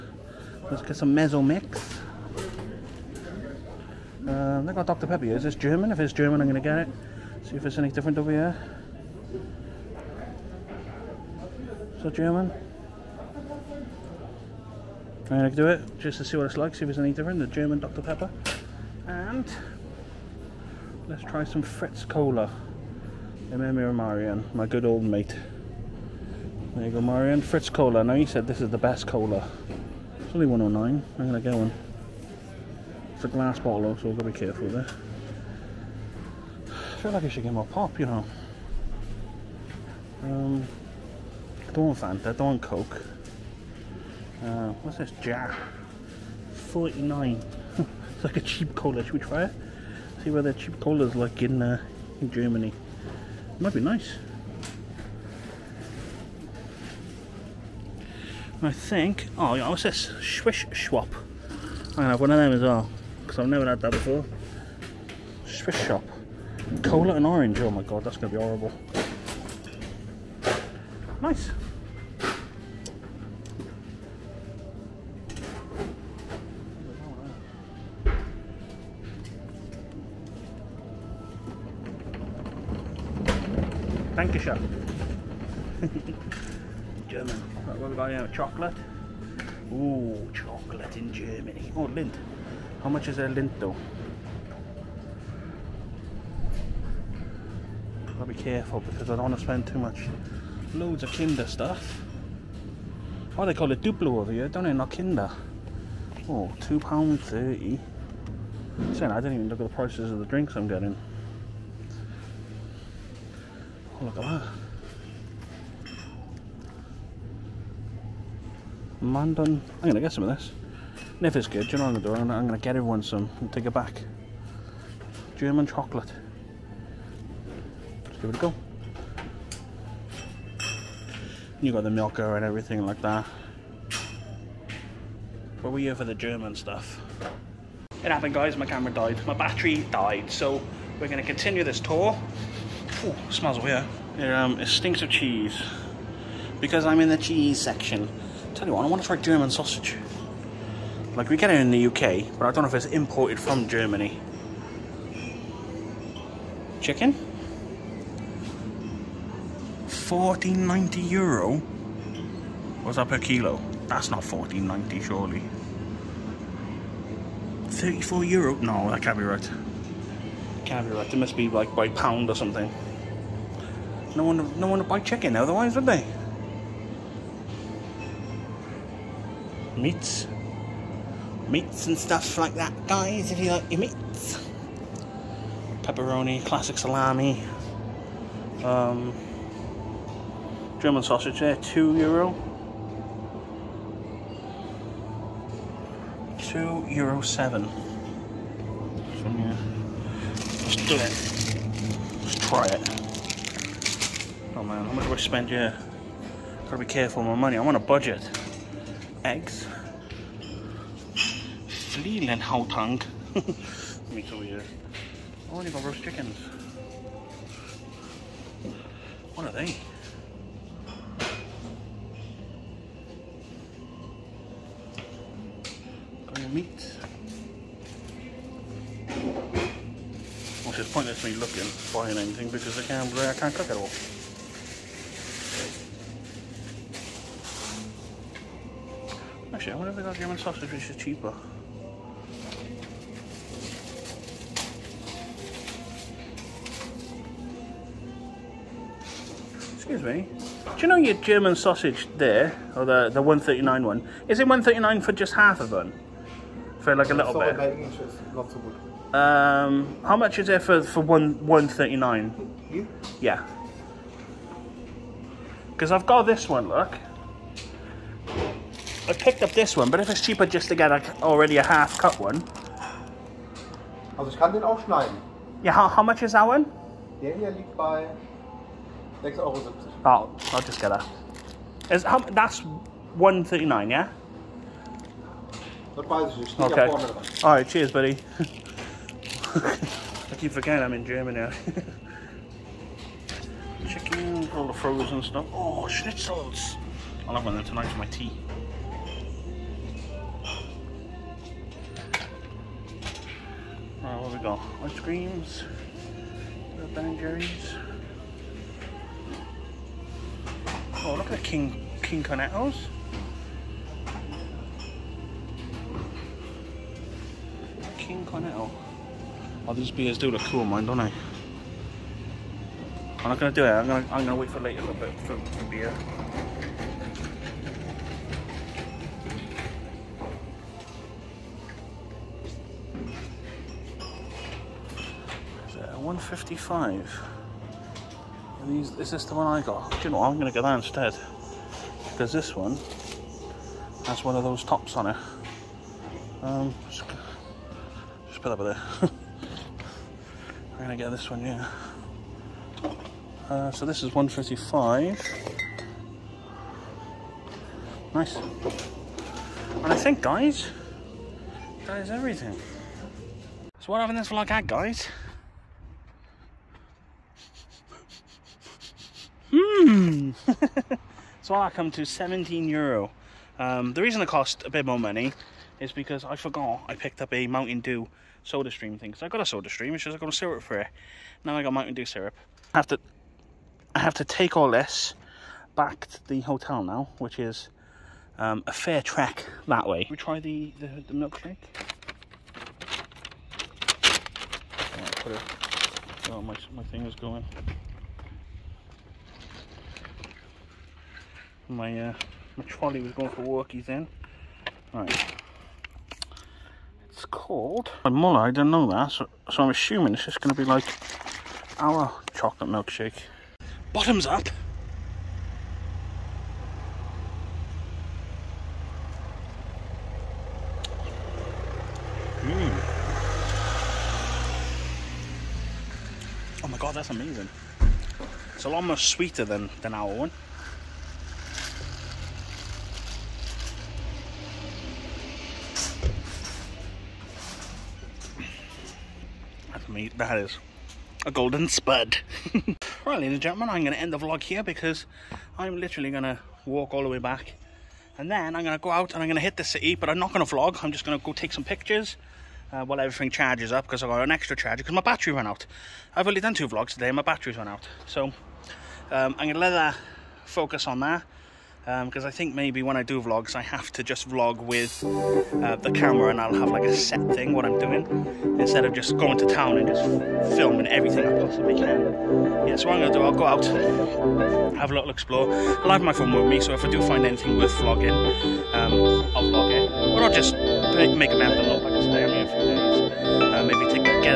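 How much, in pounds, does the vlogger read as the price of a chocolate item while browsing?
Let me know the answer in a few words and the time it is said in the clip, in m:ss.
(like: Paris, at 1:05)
£2.30, at 1:46.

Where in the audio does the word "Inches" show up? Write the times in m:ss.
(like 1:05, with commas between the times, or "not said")
4:17.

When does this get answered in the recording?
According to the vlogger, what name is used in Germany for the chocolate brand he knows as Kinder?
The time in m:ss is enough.
1:43.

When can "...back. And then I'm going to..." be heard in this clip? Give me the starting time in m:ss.
7:27.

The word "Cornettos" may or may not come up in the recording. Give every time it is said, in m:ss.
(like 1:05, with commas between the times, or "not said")
5:12, 5:18.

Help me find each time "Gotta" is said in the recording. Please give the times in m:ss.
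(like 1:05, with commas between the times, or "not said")
1:38, 3:26.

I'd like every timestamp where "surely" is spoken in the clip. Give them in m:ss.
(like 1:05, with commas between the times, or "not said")
2:45.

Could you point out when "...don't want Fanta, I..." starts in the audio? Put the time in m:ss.
0:41.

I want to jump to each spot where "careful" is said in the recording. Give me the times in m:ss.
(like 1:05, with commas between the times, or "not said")
0:34, 1:38, 3:26.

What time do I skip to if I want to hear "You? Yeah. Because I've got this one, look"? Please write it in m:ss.
4:22.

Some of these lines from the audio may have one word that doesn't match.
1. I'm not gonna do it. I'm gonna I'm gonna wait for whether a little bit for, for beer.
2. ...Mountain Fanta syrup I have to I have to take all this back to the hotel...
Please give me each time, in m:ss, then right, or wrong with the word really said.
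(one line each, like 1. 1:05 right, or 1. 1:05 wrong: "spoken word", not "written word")
1. 5:23 wrong: "later", not "whether"
2. 6:21 wrong: "Dew", not "Fanta".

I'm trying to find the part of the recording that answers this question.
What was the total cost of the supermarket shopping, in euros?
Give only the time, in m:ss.
6:12.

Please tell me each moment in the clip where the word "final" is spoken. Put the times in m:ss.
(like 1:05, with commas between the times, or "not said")
not said.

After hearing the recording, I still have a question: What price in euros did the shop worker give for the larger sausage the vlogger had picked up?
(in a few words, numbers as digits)
6,70 Euro.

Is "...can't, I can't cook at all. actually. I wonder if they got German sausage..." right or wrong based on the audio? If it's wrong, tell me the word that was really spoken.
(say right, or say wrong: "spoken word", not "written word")
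right.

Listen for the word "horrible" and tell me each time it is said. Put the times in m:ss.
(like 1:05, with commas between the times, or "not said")
1:08.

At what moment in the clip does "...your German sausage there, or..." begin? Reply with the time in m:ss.
4:10.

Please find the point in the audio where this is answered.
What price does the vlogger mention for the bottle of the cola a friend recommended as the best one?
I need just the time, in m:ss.
0:30.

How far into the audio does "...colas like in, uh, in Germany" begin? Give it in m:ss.
0:50.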